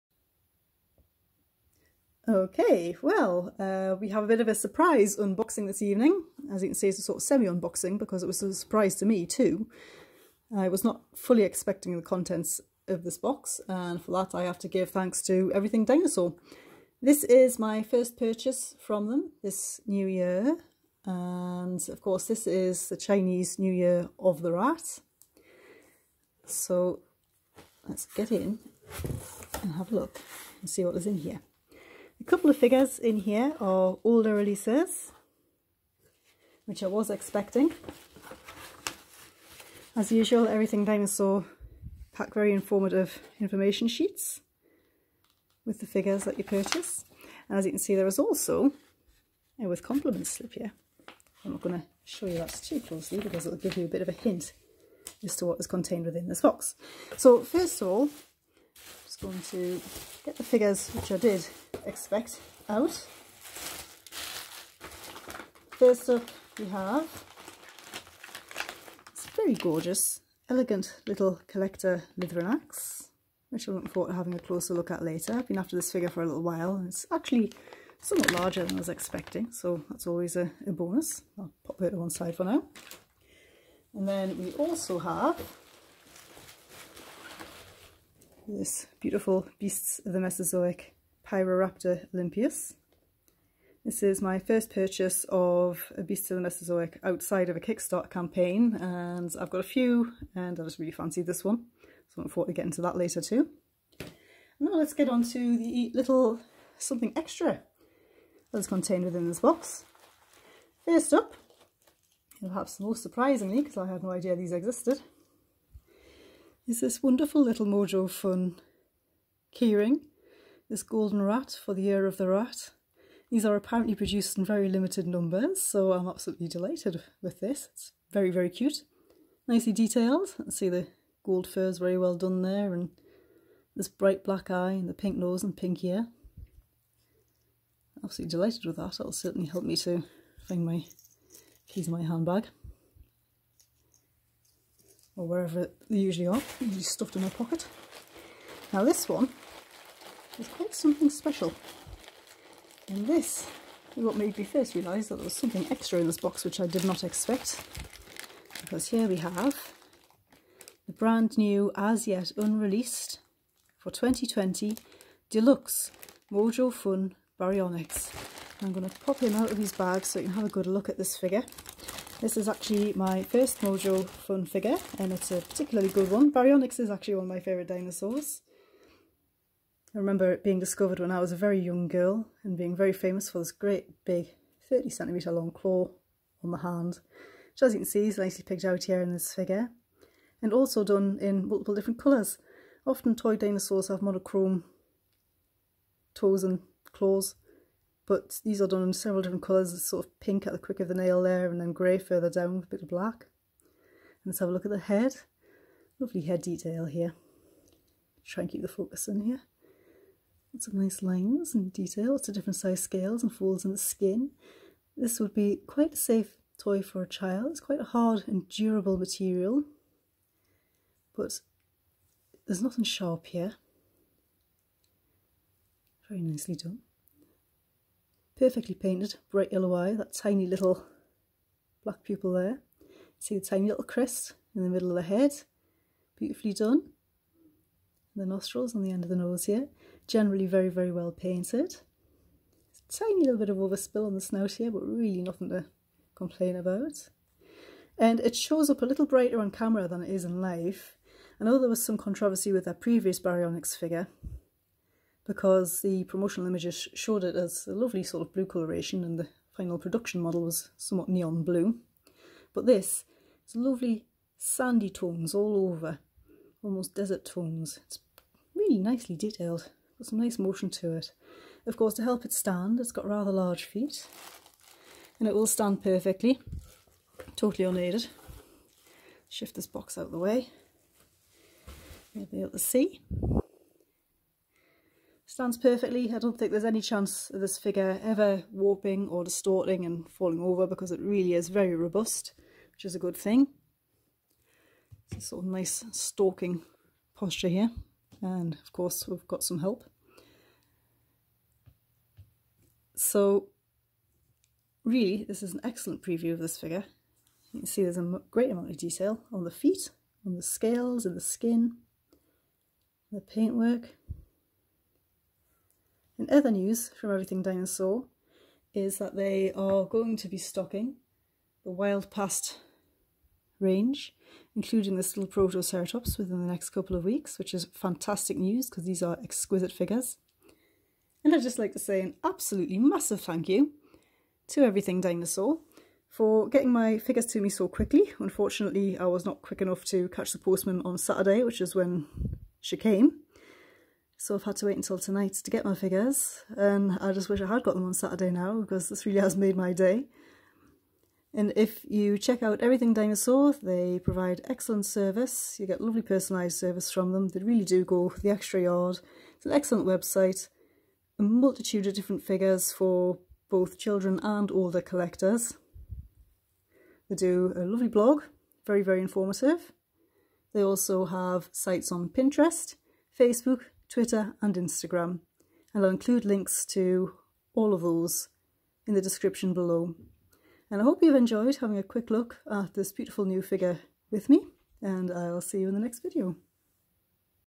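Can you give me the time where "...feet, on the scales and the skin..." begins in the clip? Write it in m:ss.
5:09.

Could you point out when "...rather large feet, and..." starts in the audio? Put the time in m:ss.
4:33.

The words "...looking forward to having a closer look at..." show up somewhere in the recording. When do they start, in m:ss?
1:13.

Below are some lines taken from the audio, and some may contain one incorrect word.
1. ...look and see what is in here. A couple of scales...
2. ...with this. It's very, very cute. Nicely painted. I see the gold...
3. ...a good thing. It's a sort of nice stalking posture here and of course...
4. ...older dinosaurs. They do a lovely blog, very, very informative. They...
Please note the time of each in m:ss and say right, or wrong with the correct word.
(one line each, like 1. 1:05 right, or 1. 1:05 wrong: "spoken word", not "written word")
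1. 0:29 wrong: "figures", not "scales"
2. 2:07 wrong: "detailed", not "painted"
3. 4:52 right
4. 6:04 wrong: "collectors", not "dinosaurs".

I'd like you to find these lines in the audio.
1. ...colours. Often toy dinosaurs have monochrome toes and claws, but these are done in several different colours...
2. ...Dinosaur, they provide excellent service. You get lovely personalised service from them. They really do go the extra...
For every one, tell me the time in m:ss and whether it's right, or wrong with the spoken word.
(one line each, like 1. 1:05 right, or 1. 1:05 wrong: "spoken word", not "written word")
1. 3:11 right
2. 5:52 right.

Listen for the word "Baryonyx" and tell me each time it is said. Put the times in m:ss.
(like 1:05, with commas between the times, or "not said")
2:47, 2:56, 4:13.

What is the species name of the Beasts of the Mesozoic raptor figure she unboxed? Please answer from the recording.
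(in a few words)
olympius.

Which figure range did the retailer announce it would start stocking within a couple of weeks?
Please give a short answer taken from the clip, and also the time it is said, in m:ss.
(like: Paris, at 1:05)
Wild Past, at 5:21.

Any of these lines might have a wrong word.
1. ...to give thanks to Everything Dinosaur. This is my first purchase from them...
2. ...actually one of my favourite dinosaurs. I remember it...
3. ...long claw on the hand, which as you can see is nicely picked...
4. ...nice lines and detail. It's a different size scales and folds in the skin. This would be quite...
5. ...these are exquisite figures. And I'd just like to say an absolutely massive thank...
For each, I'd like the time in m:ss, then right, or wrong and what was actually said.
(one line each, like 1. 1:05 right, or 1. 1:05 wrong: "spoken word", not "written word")
1. 0:14 right
2. 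2:56 right
3. 3:05 right
4. 3:30 right
5. 5:28 right.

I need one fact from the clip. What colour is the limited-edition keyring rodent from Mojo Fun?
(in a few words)
Gold.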